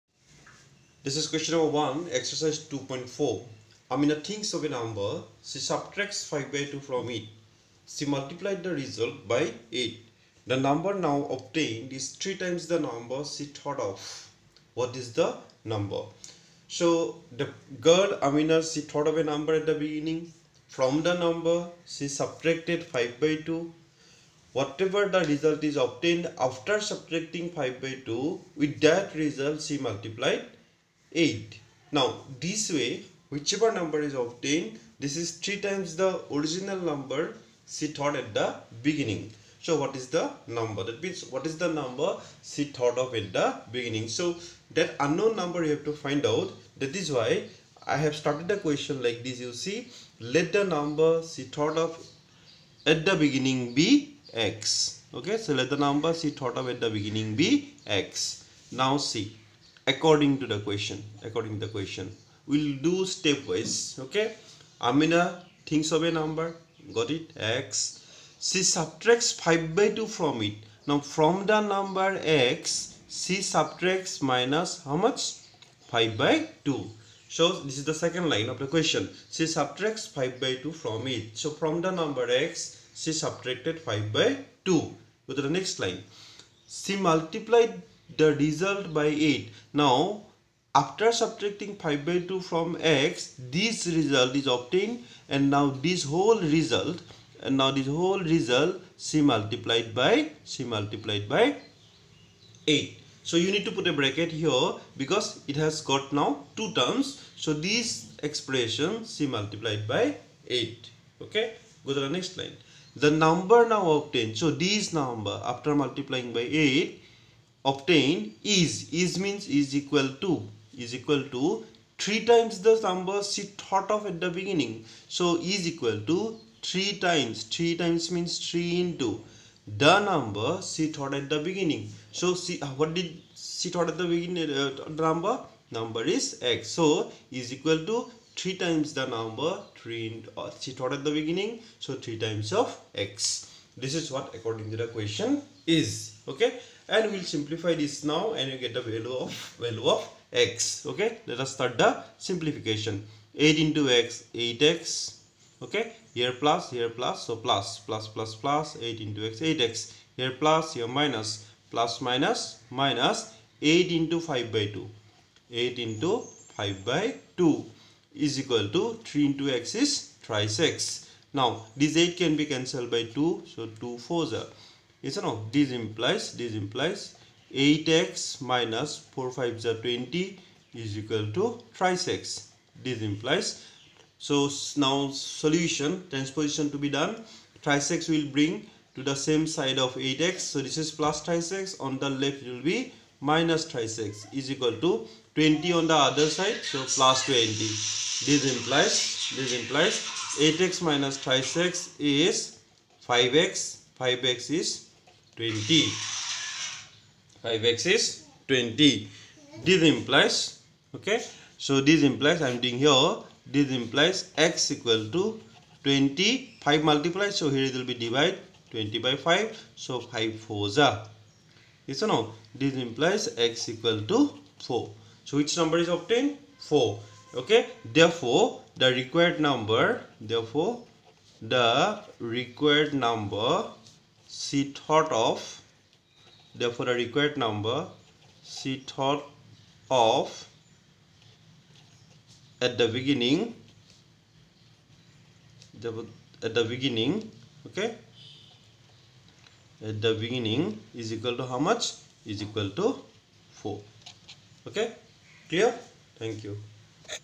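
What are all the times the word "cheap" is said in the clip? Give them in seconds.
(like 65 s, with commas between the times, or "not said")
not said.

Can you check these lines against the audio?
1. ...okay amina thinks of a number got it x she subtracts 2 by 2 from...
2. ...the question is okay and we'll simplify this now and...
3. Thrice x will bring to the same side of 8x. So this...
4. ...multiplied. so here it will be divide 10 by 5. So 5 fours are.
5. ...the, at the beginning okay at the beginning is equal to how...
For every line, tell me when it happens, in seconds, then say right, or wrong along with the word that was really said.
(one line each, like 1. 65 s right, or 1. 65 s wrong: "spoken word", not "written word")
1. 64 s wrong: "5", not "2"
2. 144 s right
3. 187 s right
4. 216 s wrong: "20", not "10"
5. 245 s right.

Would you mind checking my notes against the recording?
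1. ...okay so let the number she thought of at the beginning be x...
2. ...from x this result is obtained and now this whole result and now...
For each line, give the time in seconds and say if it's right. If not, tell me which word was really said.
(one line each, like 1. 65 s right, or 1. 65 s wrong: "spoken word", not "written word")
1. 55 s right
2. 92 s right.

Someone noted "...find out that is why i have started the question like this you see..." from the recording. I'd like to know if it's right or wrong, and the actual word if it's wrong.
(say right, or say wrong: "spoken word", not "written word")
right.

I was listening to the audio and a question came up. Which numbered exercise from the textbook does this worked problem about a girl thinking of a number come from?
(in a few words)
Exercise 2.4.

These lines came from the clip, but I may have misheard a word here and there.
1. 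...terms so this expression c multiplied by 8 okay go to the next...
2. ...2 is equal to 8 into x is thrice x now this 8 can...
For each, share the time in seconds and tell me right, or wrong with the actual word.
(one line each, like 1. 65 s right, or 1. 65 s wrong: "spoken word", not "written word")
1. 106 s right
2. 167 s wrong: "3", not "8".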